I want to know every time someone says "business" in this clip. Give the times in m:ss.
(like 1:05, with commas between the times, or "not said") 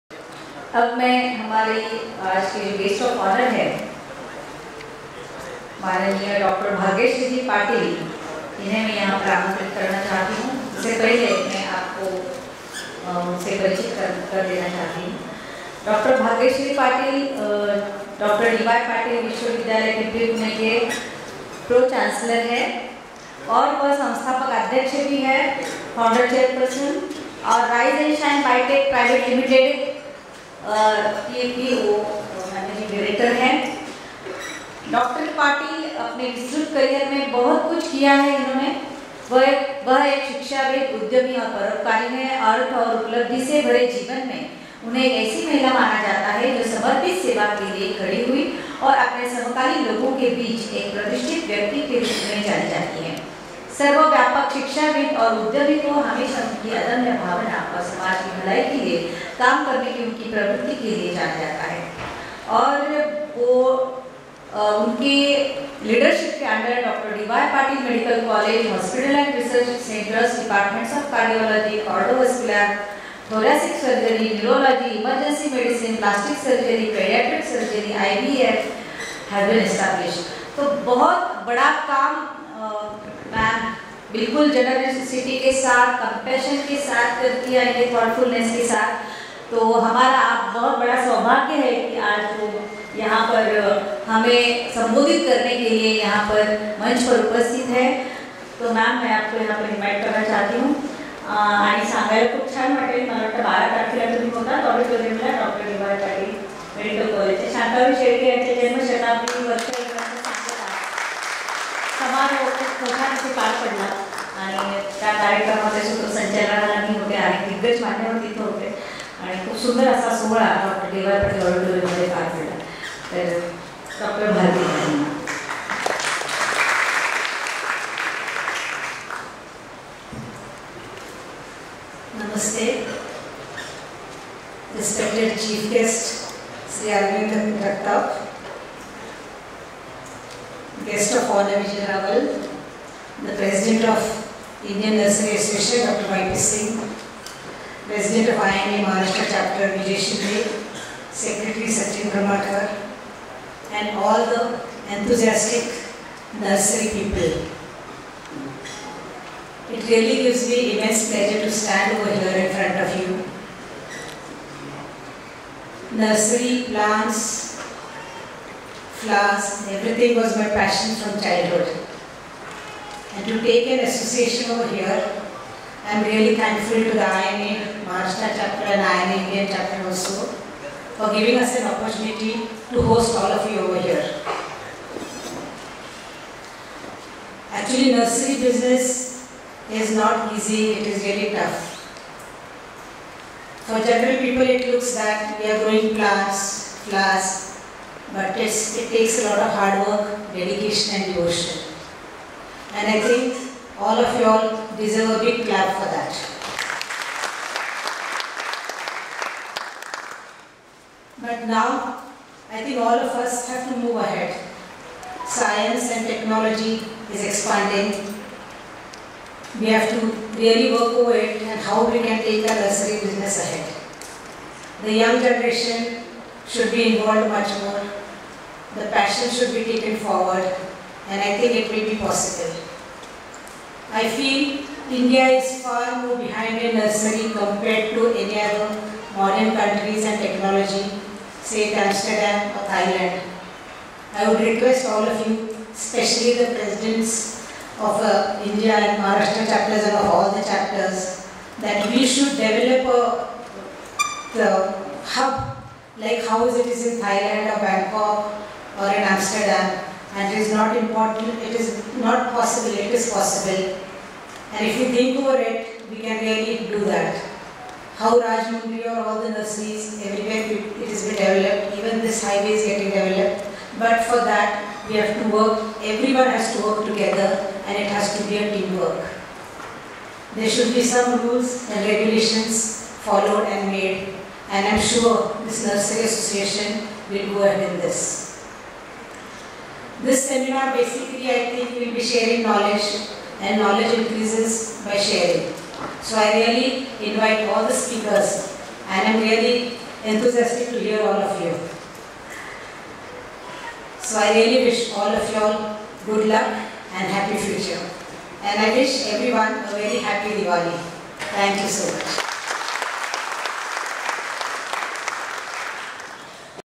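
3:08, 3:43.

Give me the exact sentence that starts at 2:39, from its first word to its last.
It really gives me immense pleasure to stand over here in front of you.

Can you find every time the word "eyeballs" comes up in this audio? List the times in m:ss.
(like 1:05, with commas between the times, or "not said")
not said.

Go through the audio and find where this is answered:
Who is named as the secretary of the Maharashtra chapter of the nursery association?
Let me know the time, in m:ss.
2:31.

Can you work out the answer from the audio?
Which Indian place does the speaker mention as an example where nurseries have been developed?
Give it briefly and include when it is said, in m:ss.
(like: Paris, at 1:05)
Rajahmundry, at 4:28.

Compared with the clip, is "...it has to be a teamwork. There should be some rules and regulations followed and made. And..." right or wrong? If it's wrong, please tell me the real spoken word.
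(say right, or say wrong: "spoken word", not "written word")
right.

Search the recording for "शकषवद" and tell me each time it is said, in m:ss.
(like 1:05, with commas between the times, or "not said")
0:40, 0:54.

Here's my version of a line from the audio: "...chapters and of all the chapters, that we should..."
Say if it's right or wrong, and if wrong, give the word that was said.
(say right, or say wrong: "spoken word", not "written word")
right.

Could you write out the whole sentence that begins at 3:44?
The young generation should be involved much more.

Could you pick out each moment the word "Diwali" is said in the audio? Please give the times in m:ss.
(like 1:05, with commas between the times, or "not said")
5:10.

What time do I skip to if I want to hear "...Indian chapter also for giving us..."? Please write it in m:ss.
2:59.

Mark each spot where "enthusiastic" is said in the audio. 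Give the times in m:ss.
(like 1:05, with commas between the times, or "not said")
2:34, 5:00.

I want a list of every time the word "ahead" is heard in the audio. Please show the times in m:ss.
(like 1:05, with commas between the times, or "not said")
3:33, 3:43, 4:47.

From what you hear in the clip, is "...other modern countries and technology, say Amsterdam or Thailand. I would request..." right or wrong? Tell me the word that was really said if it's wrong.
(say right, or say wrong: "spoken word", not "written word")
right.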